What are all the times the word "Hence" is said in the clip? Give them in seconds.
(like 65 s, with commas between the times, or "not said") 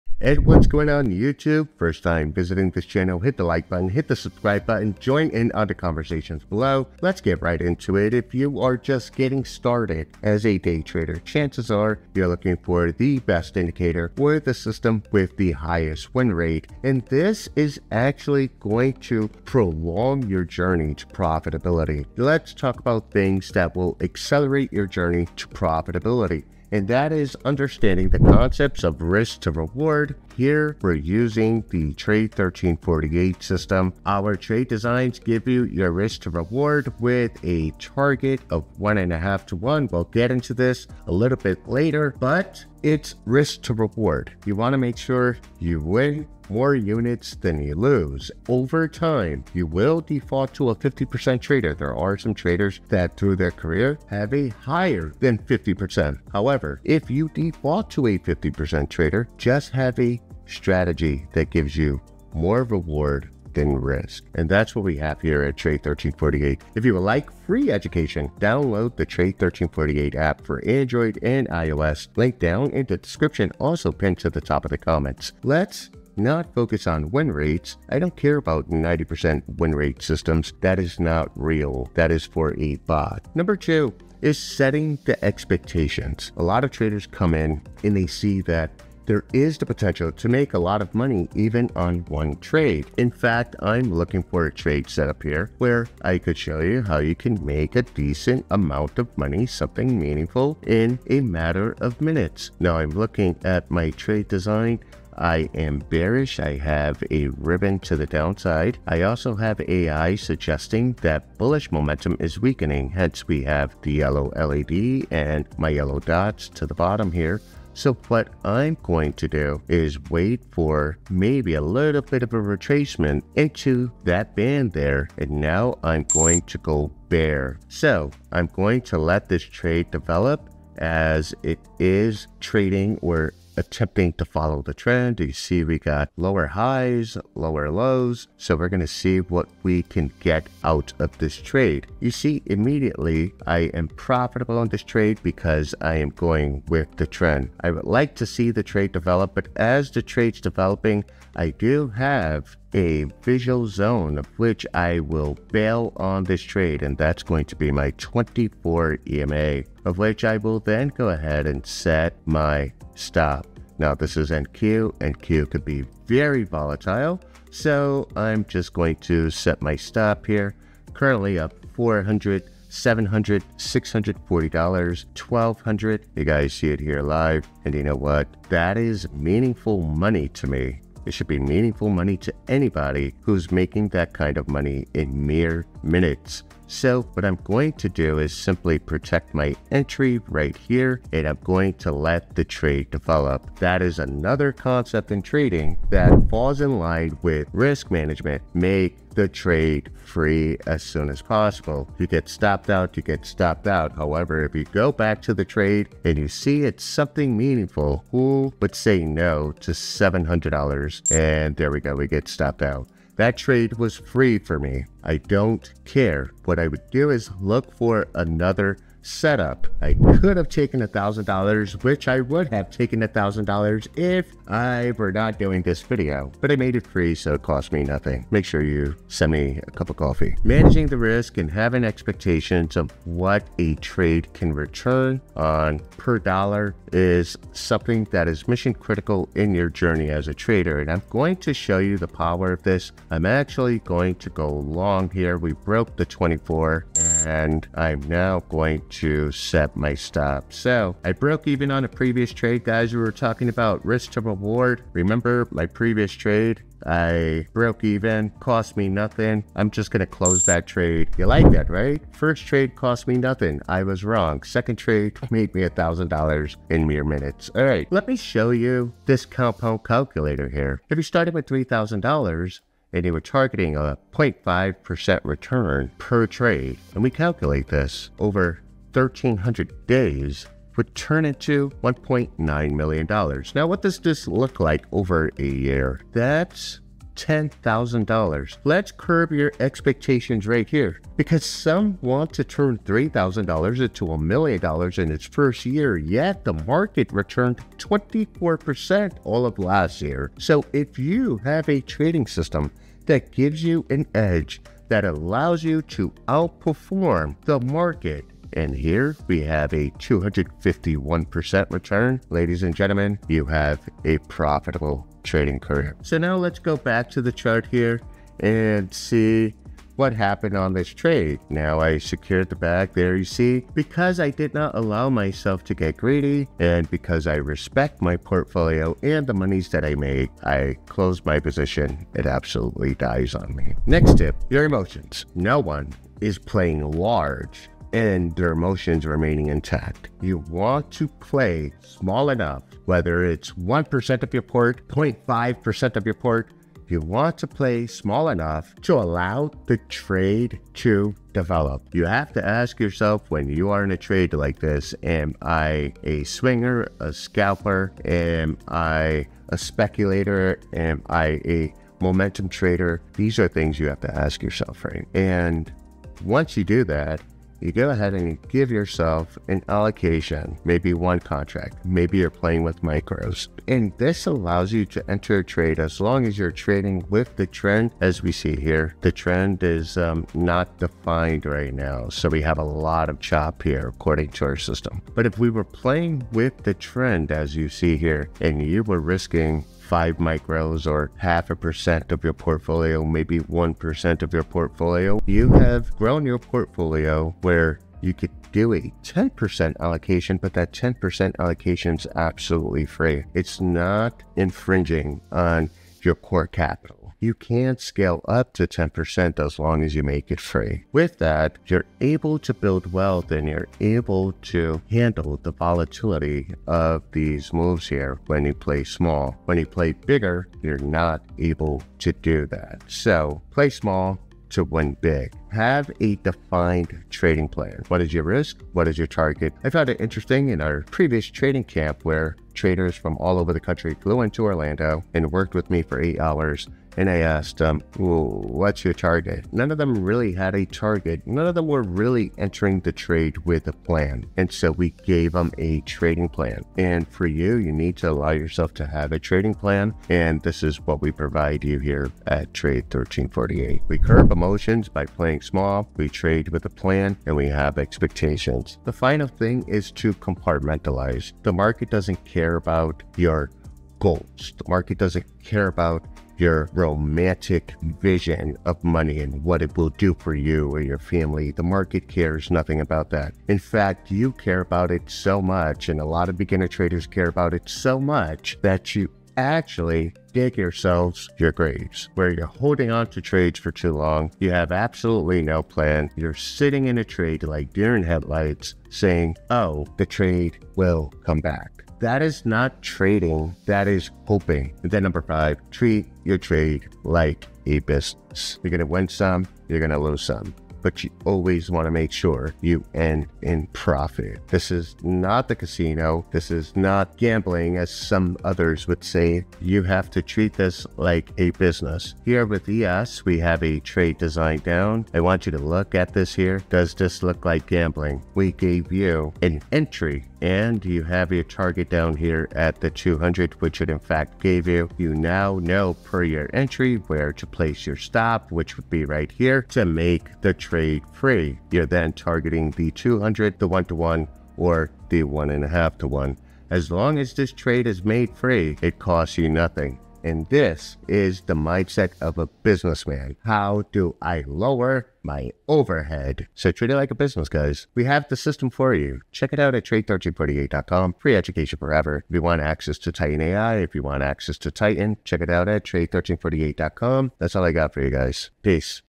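112 s.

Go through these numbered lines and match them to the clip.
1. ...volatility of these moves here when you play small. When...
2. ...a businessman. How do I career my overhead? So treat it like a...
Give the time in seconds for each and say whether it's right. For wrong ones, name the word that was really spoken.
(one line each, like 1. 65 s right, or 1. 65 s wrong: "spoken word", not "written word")
1. 415 s right
2. 542 s wrong: "lower", not "career".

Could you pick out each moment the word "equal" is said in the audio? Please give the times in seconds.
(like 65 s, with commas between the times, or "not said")
not said.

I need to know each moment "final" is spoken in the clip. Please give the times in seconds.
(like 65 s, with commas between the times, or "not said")
458 s.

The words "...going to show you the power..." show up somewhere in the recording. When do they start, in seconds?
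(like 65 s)
241 s.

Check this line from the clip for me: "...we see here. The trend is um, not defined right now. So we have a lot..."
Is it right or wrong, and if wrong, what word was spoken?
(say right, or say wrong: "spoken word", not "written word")
right.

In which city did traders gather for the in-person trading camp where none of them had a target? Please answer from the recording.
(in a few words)
Orlando.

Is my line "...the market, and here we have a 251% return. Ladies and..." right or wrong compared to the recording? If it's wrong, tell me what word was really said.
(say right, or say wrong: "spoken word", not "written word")
right.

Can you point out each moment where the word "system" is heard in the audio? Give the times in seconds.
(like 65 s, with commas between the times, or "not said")
14 s, 33 s, 80 s, 302 s, 384 s, 548 s.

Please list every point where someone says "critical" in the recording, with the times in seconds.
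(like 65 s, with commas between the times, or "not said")
238 s.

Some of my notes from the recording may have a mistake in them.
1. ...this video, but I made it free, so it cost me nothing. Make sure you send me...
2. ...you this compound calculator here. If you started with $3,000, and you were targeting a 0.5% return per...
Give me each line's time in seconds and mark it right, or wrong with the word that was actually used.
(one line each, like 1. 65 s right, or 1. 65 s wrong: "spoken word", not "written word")
1. 225 s right
2. 268 s right.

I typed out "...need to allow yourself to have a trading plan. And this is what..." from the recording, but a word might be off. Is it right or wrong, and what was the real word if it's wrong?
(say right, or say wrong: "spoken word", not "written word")
right.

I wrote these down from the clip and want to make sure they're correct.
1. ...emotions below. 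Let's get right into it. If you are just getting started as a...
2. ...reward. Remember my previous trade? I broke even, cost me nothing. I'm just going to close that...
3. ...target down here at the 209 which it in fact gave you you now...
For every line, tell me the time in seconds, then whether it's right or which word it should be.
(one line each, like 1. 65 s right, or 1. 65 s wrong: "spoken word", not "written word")
1. 5 s wrong: "conversations", not "emotions"
2. 254 s right
3. 521 s wrong: "200", not "209".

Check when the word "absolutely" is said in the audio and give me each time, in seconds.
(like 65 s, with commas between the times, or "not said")
332 s, 402 s, 484 s.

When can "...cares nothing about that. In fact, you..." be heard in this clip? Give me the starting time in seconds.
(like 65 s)
472 s.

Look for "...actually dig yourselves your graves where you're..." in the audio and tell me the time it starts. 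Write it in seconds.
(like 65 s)
479 s.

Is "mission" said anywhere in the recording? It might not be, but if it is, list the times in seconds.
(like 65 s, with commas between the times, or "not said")
238 s.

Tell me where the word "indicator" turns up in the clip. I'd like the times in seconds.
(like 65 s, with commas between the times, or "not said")
13 s.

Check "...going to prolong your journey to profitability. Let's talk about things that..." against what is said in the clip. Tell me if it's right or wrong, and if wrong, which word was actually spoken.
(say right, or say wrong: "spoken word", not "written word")
right.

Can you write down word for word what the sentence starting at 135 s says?
You see we got lower highs, lower lows.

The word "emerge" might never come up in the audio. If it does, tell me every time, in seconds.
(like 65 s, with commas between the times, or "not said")
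not said.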